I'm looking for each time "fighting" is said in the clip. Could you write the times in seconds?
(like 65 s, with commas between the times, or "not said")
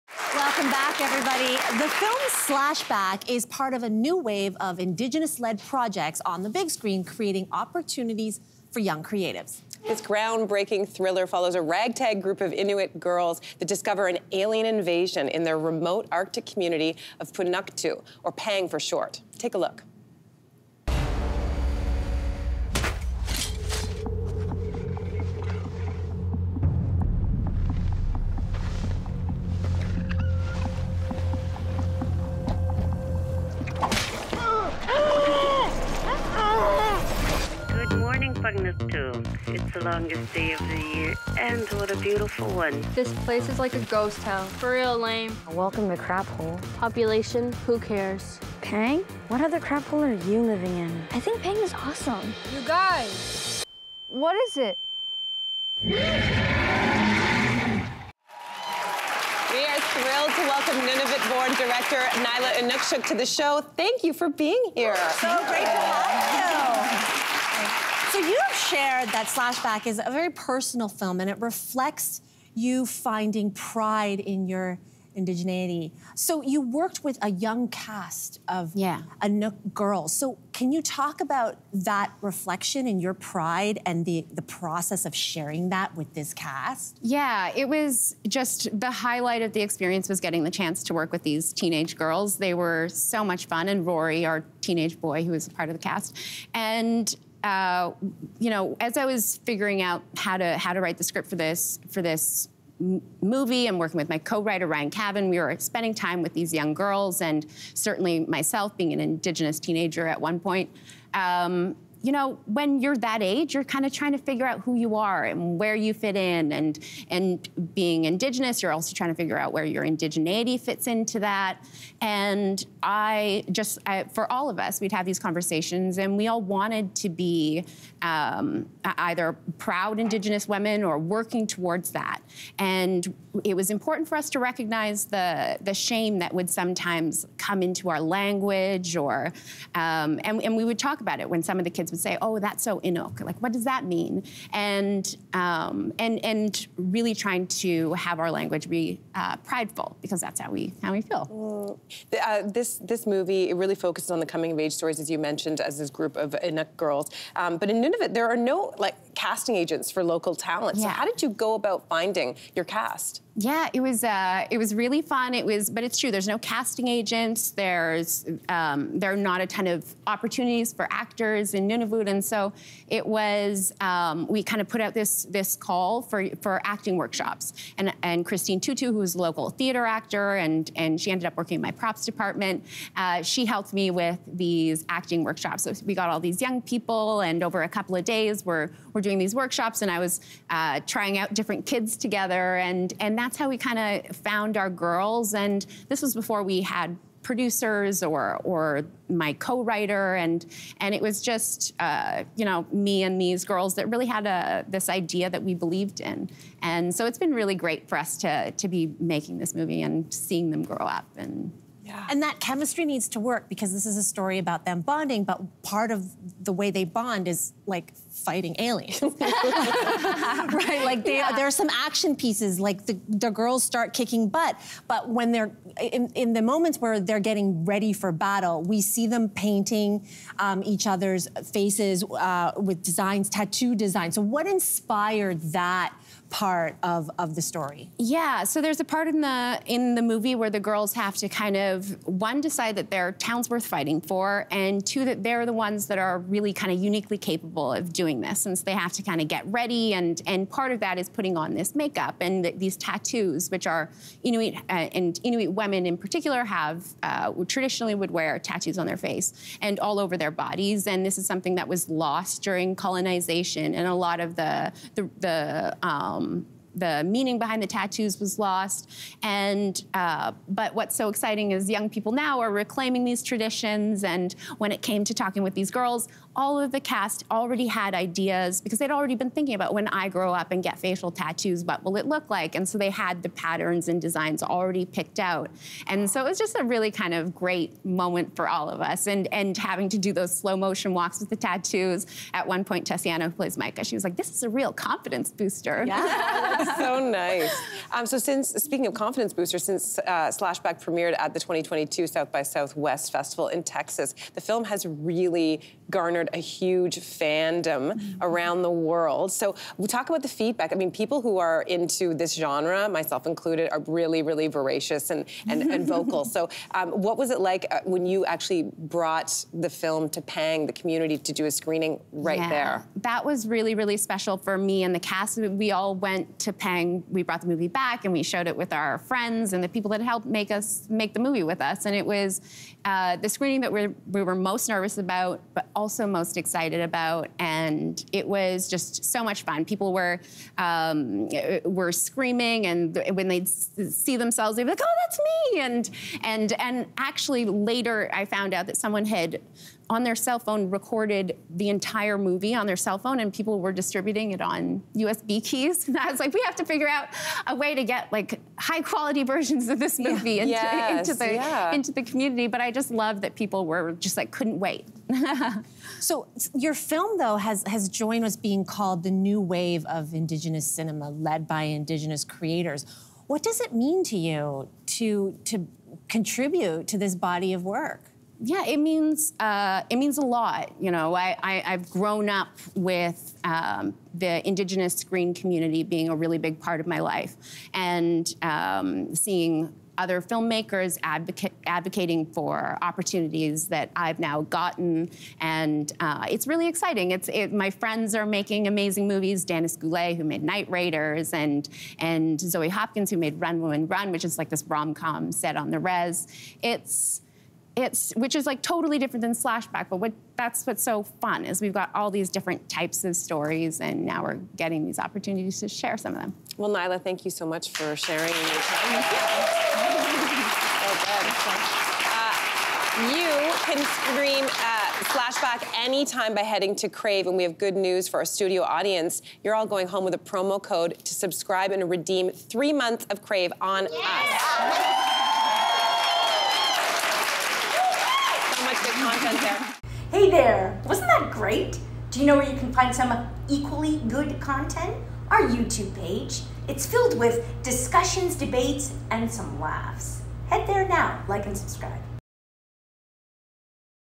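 218 s, 243 s.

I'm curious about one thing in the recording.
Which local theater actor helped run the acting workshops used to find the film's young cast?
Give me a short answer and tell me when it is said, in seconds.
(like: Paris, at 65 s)
Christine Tutu, at 178 s.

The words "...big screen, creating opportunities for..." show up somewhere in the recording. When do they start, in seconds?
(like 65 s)
6 s.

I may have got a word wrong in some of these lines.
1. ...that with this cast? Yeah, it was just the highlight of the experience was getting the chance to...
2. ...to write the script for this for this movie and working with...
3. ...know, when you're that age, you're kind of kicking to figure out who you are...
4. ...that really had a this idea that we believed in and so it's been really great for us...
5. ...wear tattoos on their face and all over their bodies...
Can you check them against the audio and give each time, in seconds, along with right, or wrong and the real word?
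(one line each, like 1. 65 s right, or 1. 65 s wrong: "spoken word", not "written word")
1. 85 s right
2. 100 s right
3. 112 s wrong: "trying", not "kicking"
4. 203 s right
5. 258 s right.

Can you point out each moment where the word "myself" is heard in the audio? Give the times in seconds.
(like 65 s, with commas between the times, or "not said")
108 s, 312 s.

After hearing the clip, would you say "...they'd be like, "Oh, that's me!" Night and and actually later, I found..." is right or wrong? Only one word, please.
wrong.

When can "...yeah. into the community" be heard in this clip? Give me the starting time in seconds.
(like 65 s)
361 s.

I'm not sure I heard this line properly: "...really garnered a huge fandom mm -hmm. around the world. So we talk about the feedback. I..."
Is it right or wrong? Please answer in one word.
right.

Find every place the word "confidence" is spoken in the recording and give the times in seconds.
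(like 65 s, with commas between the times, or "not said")
294 s, 298 s.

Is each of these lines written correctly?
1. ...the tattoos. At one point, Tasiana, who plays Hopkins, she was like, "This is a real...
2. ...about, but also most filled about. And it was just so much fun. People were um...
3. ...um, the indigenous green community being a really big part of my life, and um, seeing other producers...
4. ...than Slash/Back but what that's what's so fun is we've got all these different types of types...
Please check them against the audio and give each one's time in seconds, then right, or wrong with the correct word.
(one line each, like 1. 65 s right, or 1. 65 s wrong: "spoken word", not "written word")
1. 291 s wrong: "Maika", not "Hopkins"
2. 335 s wrong: "excited", not "filled"
3. 383 s wrong: "filmmakers", not "producers"
4. 409 s wrong: "stories", not "types".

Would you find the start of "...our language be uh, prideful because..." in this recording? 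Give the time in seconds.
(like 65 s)
148 s.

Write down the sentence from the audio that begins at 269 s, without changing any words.
And uh, but what's so exciting is young people now are reclaiming these traditions.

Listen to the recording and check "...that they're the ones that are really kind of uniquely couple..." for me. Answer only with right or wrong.
wrong.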